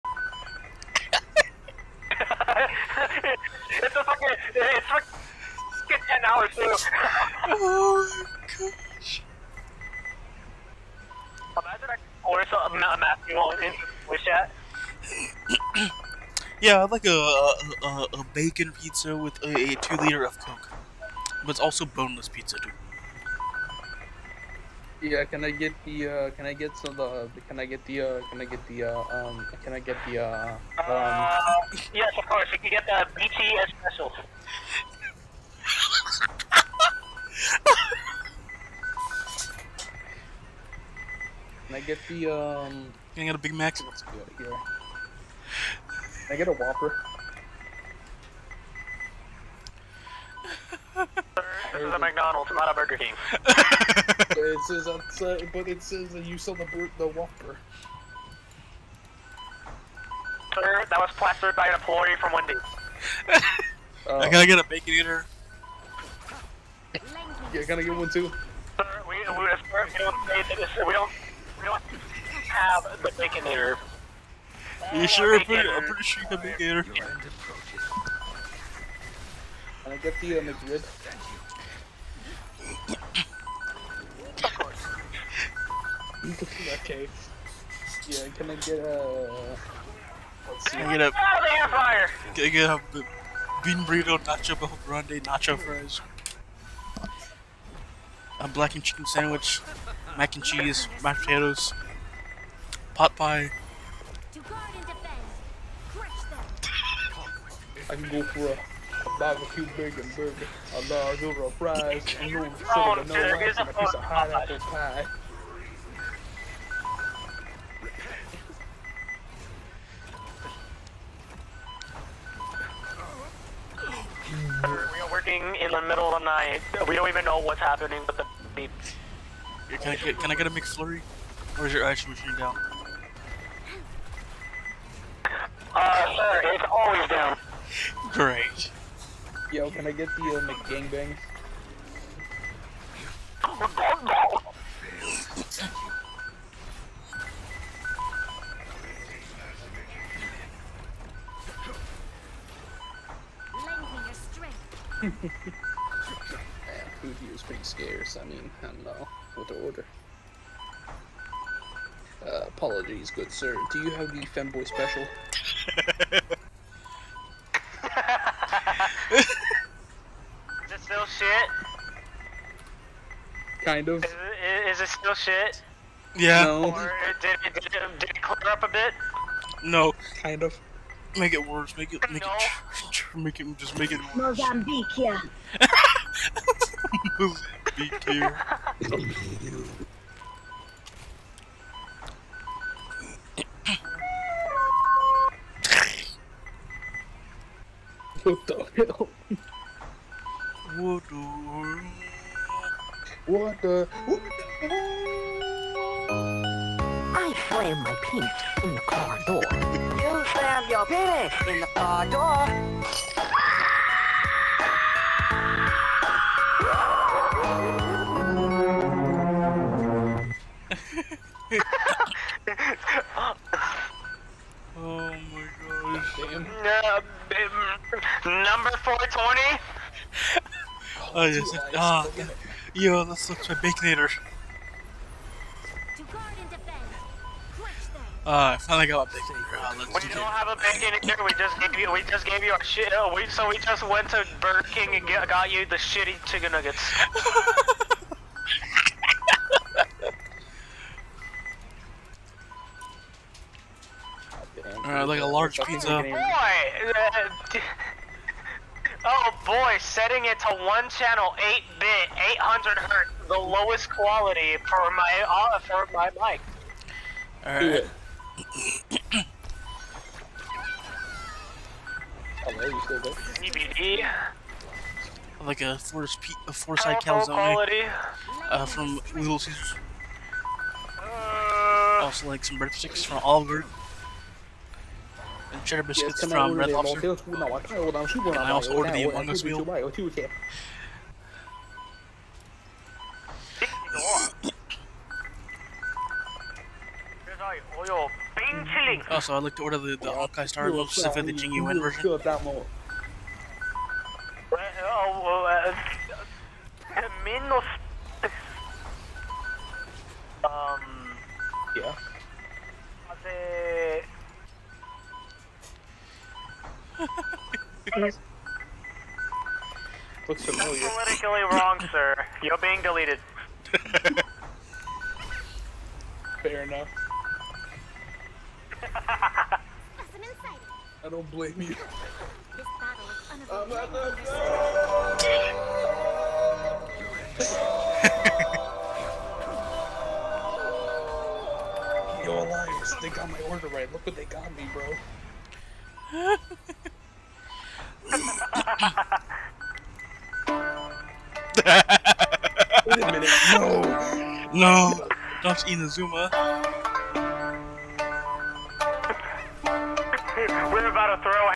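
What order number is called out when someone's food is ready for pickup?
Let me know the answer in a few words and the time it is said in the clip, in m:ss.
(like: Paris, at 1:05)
420, at 3:48.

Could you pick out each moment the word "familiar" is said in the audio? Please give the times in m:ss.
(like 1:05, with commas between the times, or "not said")
5:20.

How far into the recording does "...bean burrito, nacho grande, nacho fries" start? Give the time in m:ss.
1:33.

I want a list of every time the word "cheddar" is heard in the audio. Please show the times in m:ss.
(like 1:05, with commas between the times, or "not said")
4:45.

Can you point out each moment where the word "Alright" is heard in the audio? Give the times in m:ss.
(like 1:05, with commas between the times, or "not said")
4:14, 4:27.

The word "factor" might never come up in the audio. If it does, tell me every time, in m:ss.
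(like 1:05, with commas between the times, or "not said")
not said.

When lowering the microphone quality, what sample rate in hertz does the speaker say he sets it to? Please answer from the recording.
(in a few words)
800 hertz.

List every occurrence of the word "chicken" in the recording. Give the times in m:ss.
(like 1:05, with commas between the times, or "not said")
1:38, 4:06.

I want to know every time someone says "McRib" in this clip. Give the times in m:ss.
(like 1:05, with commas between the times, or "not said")
1:20.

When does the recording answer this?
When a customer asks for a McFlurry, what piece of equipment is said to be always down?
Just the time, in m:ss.
2:11.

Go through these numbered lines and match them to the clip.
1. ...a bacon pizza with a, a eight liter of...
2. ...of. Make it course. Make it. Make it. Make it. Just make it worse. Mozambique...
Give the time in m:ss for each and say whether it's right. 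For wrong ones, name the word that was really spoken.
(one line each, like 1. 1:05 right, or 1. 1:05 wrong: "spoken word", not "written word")
1. 0:18 wrong: "two", not "eight"
2. 3:00 wrong: "worse", not "course".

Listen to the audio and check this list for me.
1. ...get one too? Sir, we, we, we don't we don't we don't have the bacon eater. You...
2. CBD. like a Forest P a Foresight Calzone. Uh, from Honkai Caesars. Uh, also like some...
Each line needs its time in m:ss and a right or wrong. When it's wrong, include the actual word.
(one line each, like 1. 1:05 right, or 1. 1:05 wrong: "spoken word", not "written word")
1. 1:07 right
2. 4:33 wrong: "Little", not "Honkai".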